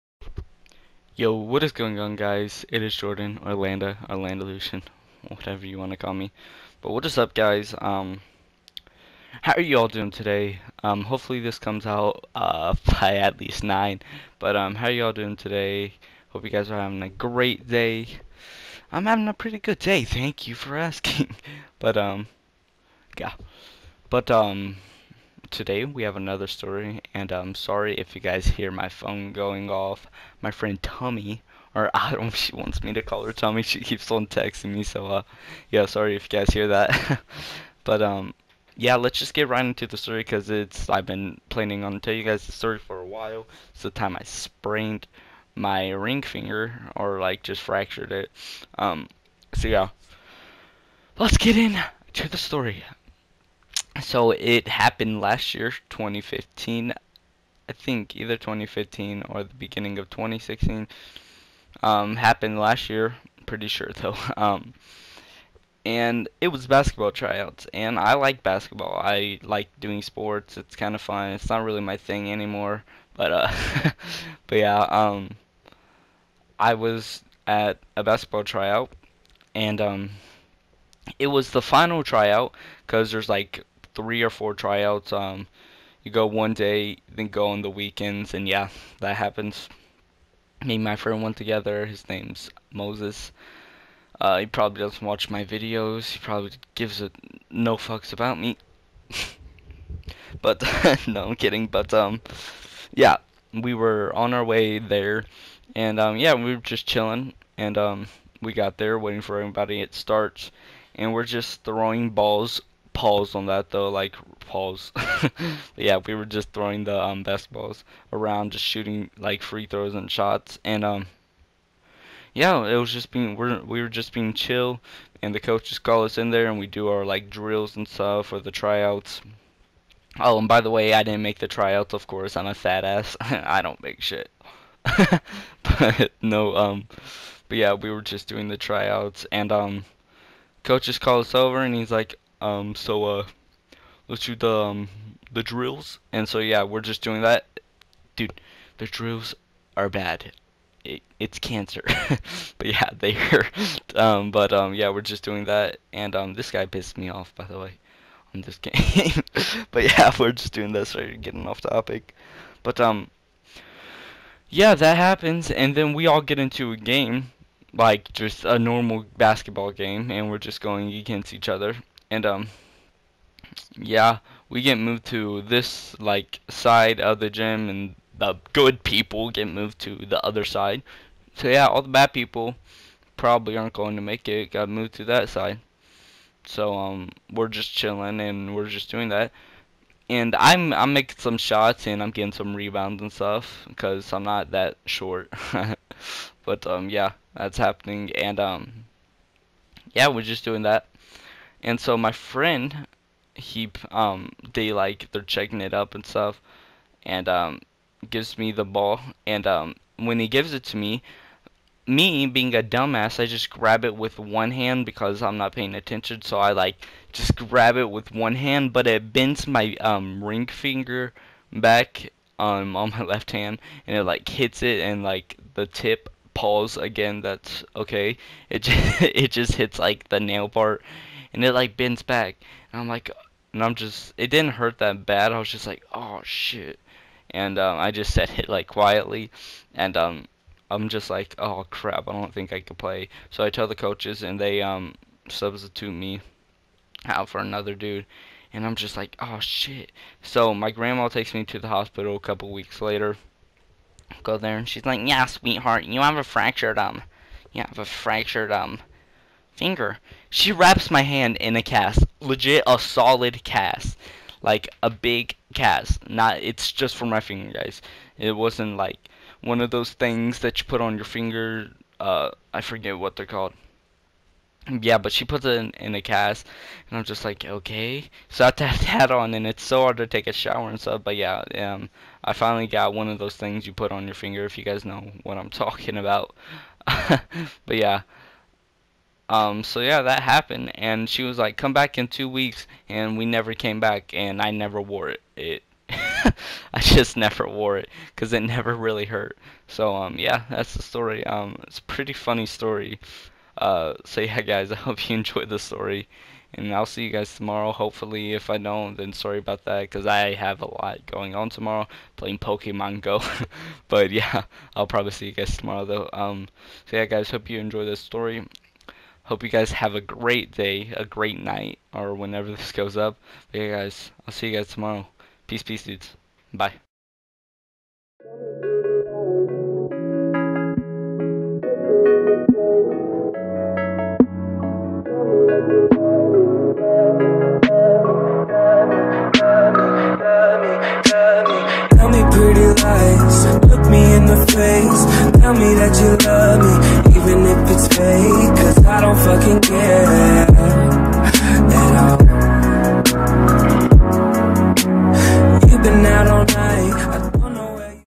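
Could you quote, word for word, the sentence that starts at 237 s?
And um, I just said it like quietly, and um, I'm just like, oh crap, I don't think I could play.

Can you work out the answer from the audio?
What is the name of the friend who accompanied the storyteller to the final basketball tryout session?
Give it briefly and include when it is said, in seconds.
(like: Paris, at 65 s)
Moses, at 92 s.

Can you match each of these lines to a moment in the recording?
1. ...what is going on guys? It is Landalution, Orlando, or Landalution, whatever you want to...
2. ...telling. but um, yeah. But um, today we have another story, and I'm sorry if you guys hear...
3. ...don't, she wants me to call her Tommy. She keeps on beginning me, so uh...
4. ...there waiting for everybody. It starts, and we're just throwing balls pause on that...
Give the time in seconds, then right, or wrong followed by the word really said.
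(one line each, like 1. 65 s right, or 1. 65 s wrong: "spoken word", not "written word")
1. 1 s wrong: "Jordan", not "Landalution"
2. 20 s wrong: "asking", not "telling"
3. 32 s wrong: "texting", not "beginning"
4. 108 s right.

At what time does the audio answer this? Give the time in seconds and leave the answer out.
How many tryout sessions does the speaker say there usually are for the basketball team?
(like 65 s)
83 s.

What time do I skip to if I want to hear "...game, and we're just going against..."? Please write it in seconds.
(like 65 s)
169 s.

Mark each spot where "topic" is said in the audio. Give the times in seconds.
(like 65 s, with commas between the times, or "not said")
161 s.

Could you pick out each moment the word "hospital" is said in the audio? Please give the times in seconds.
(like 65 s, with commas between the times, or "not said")
251 s.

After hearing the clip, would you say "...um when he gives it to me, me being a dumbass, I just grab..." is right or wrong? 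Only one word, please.
right.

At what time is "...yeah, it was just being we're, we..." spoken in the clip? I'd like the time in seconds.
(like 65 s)
122 s.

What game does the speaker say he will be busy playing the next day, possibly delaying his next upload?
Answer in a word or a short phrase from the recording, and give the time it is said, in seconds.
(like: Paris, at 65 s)
Pokemon Go, at 312 s.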